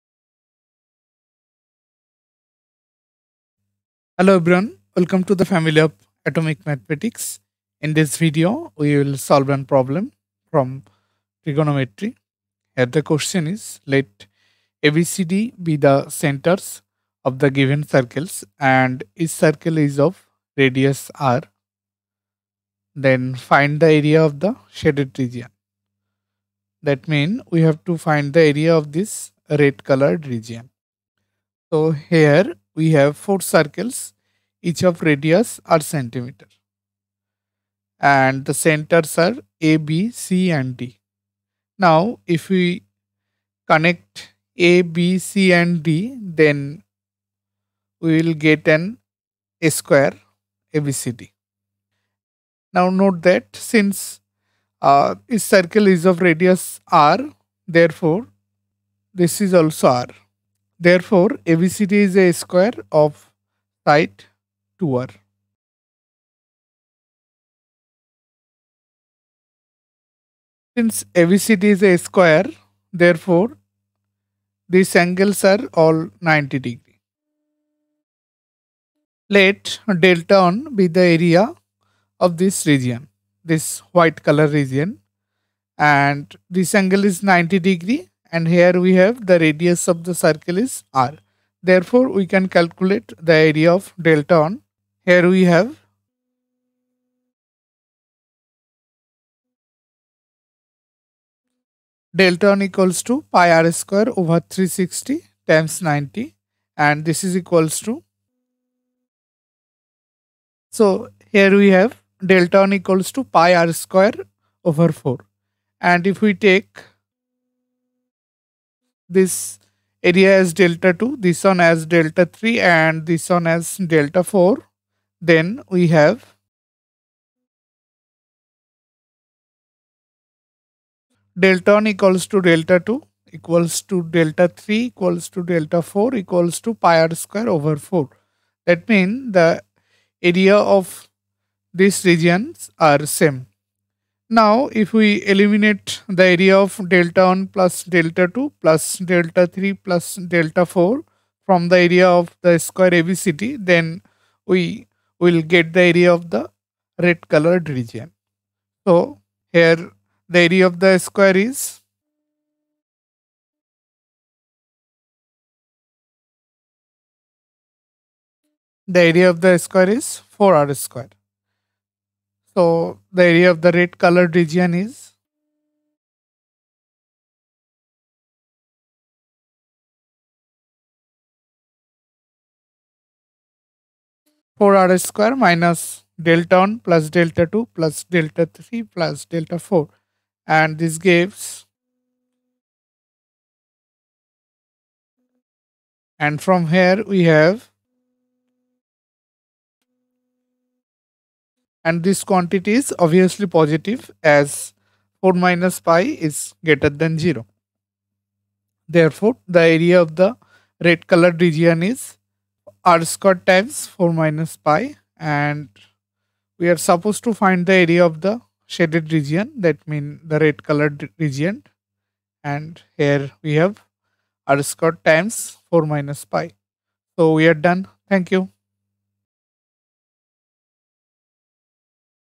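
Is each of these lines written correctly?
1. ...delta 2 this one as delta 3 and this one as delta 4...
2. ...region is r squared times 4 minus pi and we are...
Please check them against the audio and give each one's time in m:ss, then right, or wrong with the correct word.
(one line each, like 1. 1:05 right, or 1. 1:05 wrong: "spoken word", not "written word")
1. 2:00 right
2. 3:31 right.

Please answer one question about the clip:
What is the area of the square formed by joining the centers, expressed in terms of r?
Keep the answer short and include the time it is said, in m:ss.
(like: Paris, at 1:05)
4r squared, at 2:50.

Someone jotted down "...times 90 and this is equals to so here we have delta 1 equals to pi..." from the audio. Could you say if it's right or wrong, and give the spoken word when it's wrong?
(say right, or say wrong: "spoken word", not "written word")
right.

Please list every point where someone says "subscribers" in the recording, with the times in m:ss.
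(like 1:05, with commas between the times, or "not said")
not said.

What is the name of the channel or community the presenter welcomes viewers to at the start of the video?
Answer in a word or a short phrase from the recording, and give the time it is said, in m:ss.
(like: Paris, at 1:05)
atomic mathematics, at 0:06.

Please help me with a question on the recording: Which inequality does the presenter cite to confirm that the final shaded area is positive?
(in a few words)
4 - pi > 0.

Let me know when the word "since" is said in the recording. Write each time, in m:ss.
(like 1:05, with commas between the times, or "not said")
0:53, 1:10.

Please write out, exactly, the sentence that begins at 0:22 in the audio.
Then find the area of the shaded region.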